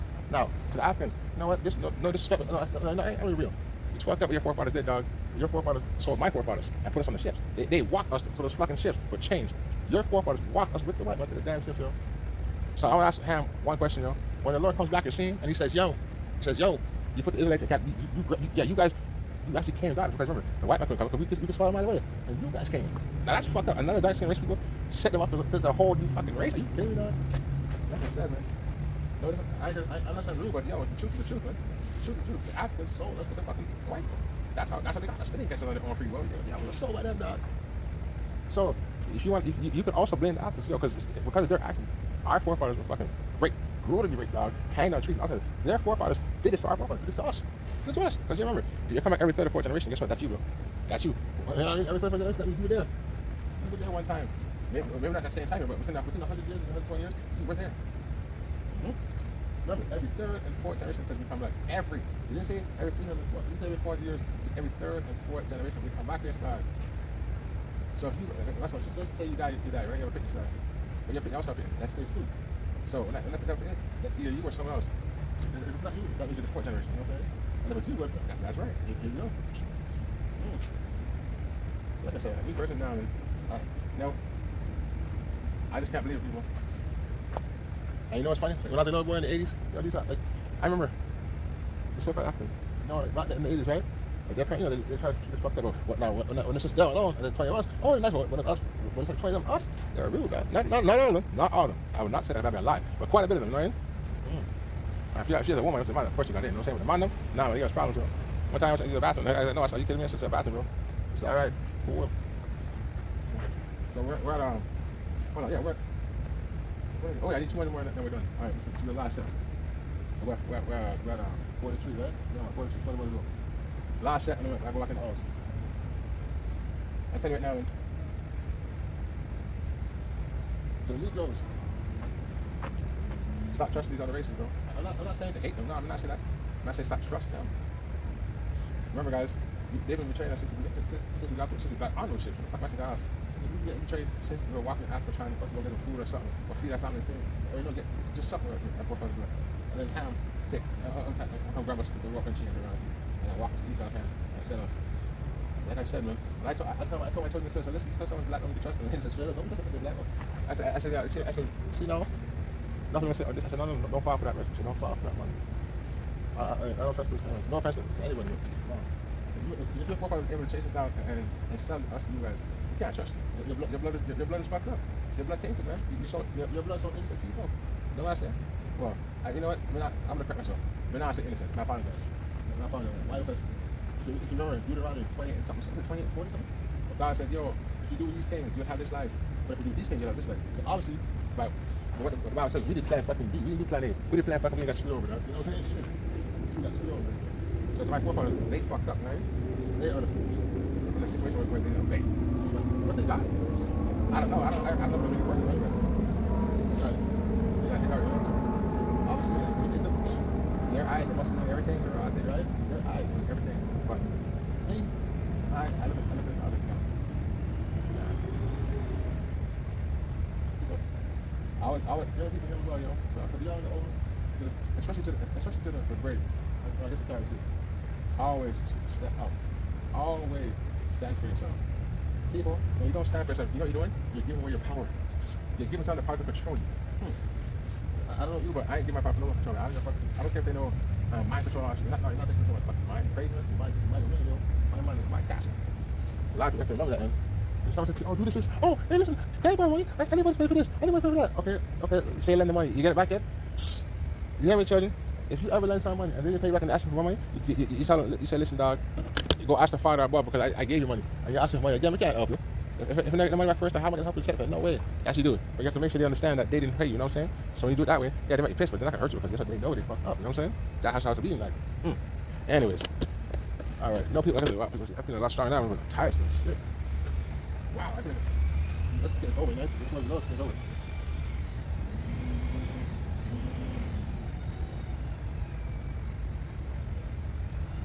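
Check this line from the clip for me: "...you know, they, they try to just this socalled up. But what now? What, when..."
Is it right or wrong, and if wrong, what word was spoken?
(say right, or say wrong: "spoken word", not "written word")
wrong: "fucked", not "socalled".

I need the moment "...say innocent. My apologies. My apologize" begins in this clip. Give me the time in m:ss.
3:01.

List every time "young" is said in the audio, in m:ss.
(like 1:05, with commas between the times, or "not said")
3:43.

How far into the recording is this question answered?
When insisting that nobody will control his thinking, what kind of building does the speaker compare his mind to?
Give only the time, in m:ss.
4:05.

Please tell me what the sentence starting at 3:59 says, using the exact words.
I don't, fuck, I don't care if they know um, mind control or shit.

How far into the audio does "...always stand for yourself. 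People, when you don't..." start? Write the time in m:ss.
3:49.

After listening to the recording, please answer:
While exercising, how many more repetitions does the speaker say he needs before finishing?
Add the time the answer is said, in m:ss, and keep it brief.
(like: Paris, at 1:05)
200, at 1:57.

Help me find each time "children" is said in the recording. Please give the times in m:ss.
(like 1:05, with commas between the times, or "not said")
2:37, 4:14.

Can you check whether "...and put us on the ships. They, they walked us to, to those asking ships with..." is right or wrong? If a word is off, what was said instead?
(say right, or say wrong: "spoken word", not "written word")
wrong: "fucking", not "asking".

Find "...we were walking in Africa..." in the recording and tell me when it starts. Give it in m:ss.
2:24.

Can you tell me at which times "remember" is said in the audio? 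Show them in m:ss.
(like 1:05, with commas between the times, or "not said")
0:20, 0:48, 0:59, 1:30, 2:18, 3:04, 4:06.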